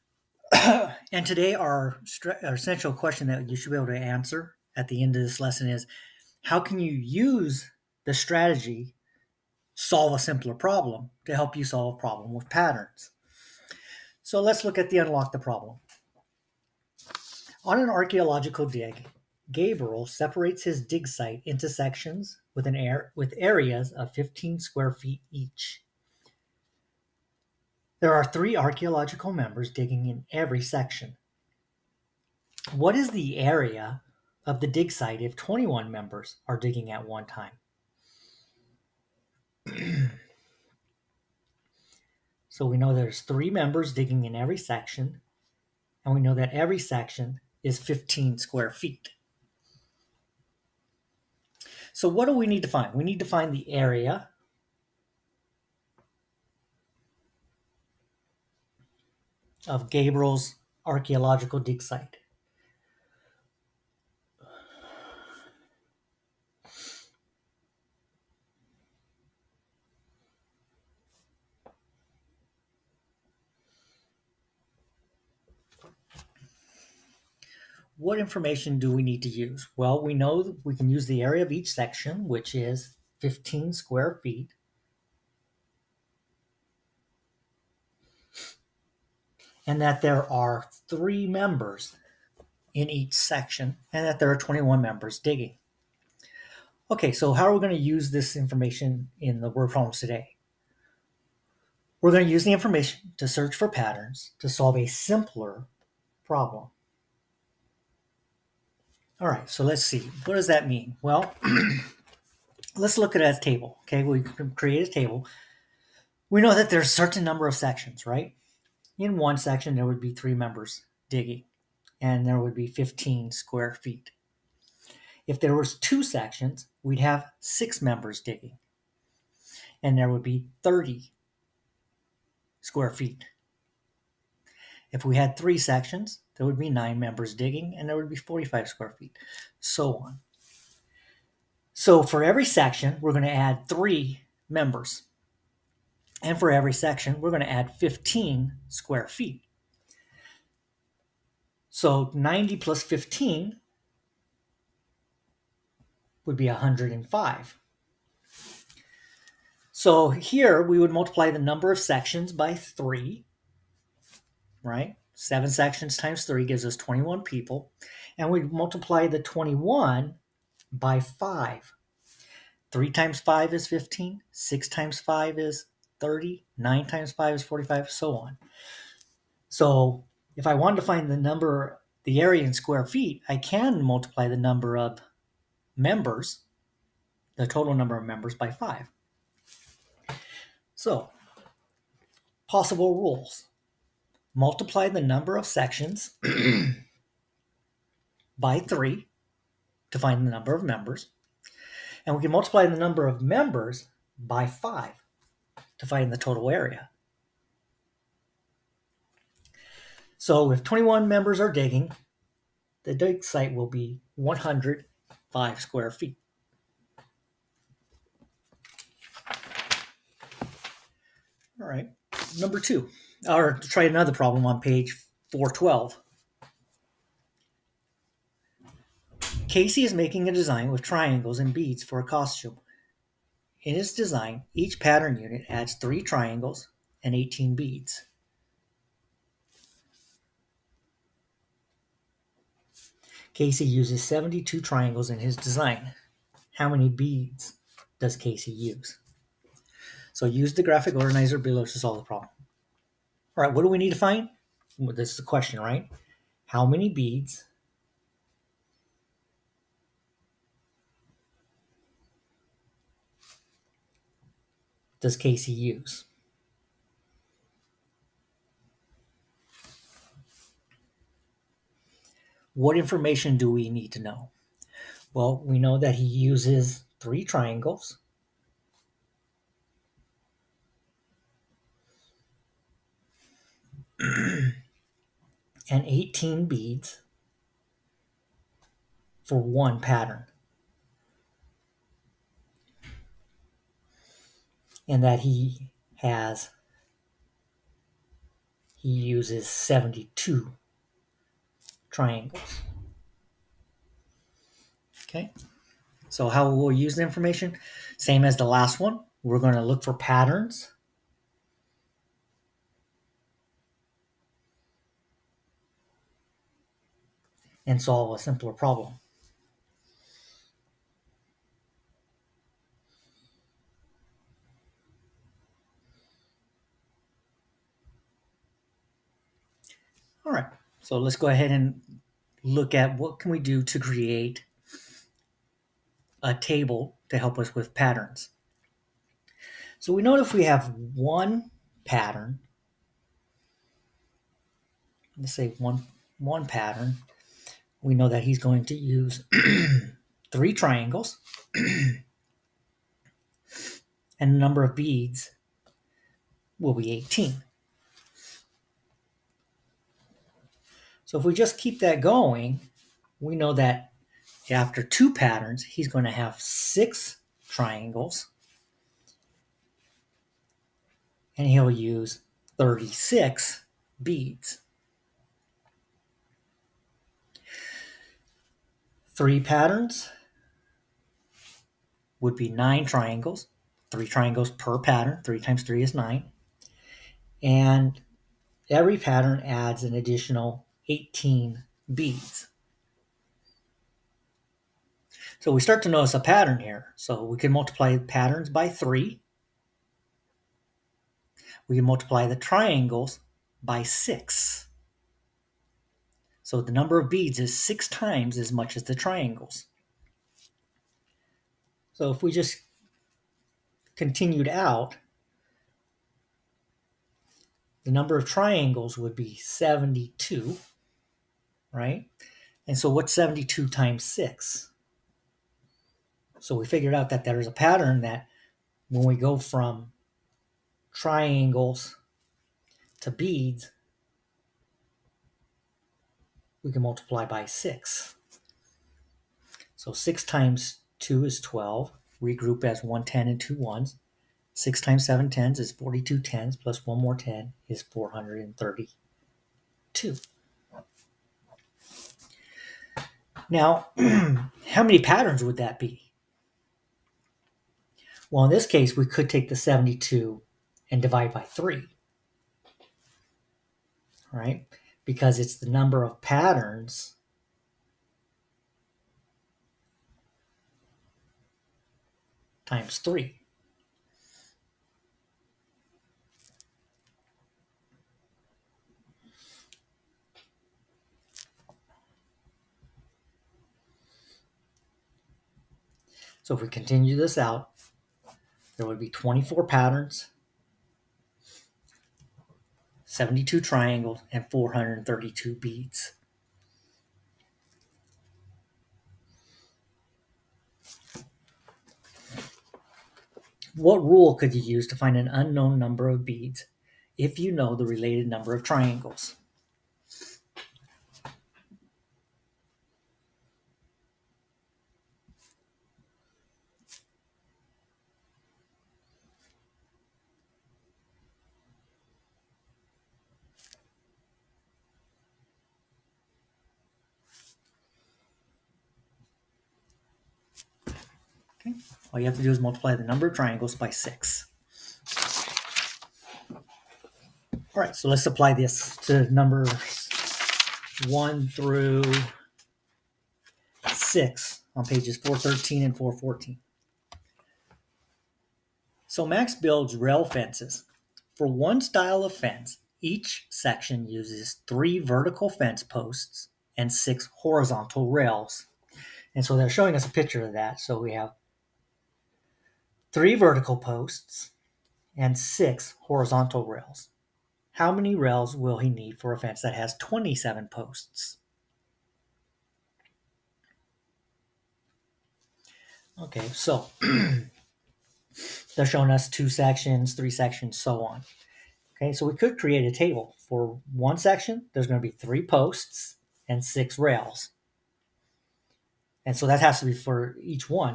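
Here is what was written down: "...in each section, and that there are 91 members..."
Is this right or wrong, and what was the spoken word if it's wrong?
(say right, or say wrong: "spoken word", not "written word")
wrong: "21", not "91".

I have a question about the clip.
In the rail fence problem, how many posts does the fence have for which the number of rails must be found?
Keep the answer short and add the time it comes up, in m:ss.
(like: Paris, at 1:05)
27, at 9:29.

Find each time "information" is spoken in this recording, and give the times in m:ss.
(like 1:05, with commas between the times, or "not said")
1:18, 1:38, 1:42, 4:32, 5:07.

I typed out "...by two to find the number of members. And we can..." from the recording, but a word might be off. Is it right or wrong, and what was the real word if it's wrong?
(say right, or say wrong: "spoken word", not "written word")
wrong: "three", not "two".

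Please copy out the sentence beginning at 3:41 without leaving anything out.
All right, number two or try another problem on page 412.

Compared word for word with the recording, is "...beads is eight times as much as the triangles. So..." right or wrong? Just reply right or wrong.
wrong.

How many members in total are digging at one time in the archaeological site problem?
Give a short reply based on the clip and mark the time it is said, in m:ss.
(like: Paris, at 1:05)
21, at 0:35.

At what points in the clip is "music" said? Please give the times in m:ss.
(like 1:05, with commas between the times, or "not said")
not said.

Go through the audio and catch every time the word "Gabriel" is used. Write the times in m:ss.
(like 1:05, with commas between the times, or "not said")
0:19, 0:59.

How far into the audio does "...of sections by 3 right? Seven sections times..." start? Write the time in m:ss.
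2:41.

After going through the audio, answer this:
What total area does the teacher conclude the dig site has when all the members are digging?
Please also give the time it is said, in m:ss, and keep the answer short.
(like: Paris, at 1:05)
105 square feet, at 3:34.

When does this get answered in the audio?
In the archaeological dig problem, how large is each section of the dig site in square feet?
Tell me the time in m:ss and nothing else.
0:24.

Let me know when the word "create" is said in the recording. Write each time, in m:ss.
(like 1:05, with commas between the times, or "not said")
1:54, 5:33, 9:42.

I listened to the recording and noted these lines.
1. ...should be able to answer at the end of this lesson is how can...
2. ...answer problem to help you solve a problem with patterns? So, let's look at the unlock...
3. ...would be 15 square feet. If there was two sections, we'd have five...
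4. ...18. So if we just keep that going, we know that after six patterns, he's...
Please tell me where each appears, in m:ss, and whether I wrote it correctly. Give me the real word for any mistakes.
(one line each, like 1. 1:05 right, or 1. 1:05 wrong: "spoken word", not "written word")
1. 0:03 right
2. 0:10 wrong: "simpler", not "answer"
3. 2:02 wrong: "six", not "five"
4. 5:56 wrong: "two", not "six".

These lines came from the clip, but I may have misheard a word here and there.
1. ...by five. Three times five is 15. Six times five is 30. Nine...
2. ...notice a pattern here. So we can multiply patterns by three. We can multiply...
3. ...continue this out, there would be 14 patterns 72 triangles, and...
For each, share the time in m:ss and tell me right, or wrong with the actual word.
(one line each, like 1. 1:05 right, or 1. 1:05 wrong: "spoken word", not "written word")
1. 2:50 right
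2. 6:35 right
3. 8:06 wrong: "24", not "14".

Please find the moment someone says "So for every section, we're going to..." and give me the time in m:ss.
2:21.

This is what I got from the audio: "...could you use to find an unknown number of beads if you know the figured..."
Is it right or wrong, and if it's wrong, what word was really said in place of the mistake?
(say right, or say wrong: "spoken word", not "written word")
wrong: "related", not "figured".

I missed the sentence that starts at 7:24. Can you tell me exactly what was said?
6 times 7 tens is 42 tens, plus one more 10 is 432.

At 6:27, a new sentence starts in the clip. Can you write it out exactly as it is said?
And every pattern adds an additional 18 beads.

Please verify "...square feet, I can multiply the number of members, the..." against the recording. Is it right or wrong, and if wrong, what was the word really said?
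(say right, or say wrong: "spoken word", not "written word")
right.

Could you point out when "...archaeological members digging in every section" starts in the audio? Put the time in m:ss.
0:28.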